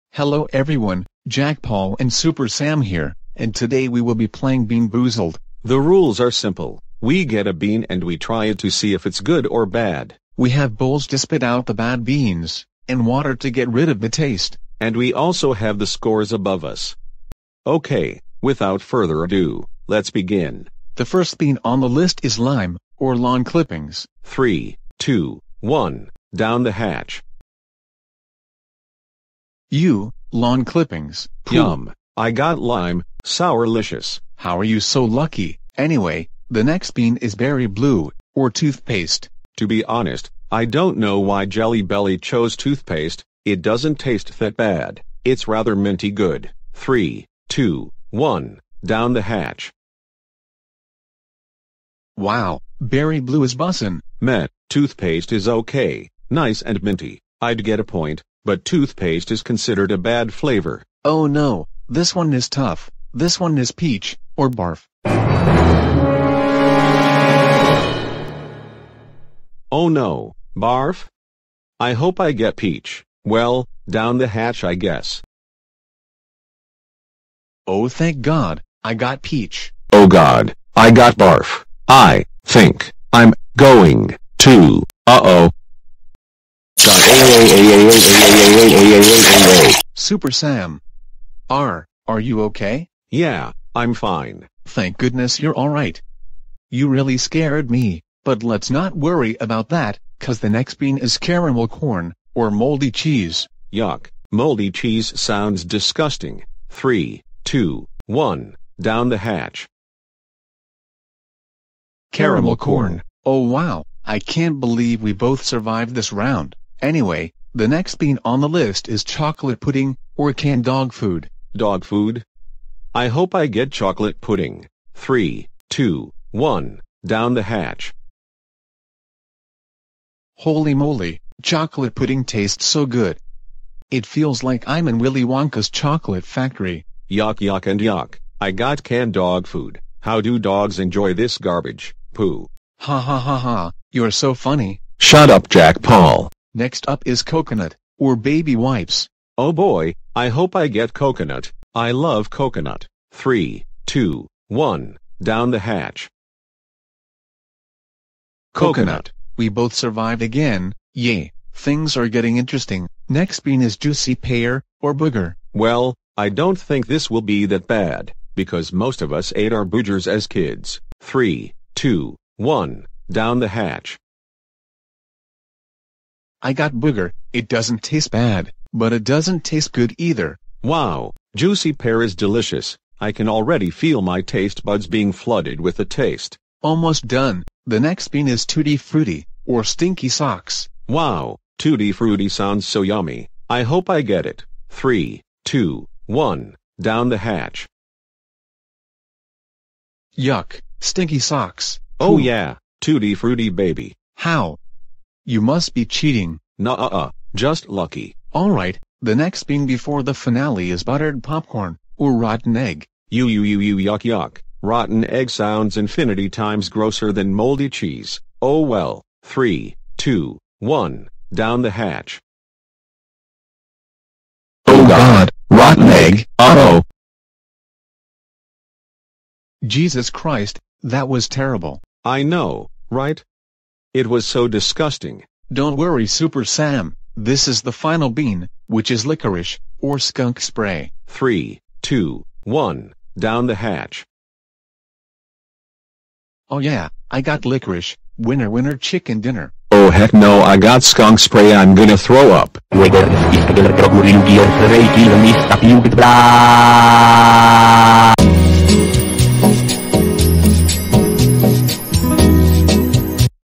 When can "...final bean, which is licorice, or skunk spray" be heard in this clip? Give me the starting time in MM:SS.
03:57.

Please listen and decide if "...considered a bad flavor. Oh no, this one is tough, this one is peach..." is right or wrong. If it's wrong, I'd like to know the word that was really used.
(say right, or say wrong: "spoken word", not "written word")
right.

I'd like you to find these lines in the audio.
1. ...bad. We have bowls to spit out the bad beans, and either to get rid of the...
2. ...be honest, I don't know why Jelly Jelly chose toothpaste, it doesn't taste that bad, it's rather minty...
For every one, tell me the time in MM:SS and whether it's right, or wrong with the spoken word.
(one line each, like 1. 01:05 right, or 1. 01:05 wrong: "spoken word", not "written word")
1. 00:09 wrong: "water", not "either"
2. 00:39 wrong: "Belly", not "Jelly".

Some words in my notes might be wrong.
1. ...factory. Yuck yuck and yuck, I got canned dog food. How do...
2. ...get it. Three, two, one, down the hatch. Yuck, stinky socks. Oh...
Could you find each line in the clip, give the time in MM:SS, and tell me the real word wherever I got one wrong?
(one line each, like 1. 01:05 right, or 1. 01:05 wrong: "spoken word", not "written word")
1. 02:16 right
2. 03:14 right.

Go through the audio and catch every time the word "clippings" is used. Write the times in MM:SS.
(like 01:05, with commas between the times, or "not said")
00:23, 00:30.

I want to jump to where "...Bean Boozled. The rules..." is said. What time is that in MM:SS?
00:04.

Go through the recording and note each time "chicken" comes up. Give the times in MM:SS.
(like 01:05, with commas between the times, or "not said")
04:08.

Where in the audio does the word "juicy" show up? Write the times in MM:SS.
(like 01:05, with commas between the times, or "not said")
02:43, 03:01.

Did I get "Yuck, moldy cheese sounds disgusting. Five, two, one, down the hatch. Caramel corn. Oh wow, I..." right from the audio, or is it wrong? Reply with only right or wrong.
wrong.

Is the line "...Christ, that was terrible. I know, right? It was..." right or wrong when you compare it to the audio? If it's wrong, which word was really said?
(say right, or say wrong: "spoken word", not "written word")
right.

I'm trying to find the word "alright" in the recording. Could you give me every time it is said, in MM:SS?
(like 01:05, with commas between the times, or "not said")
01:35, 03:28.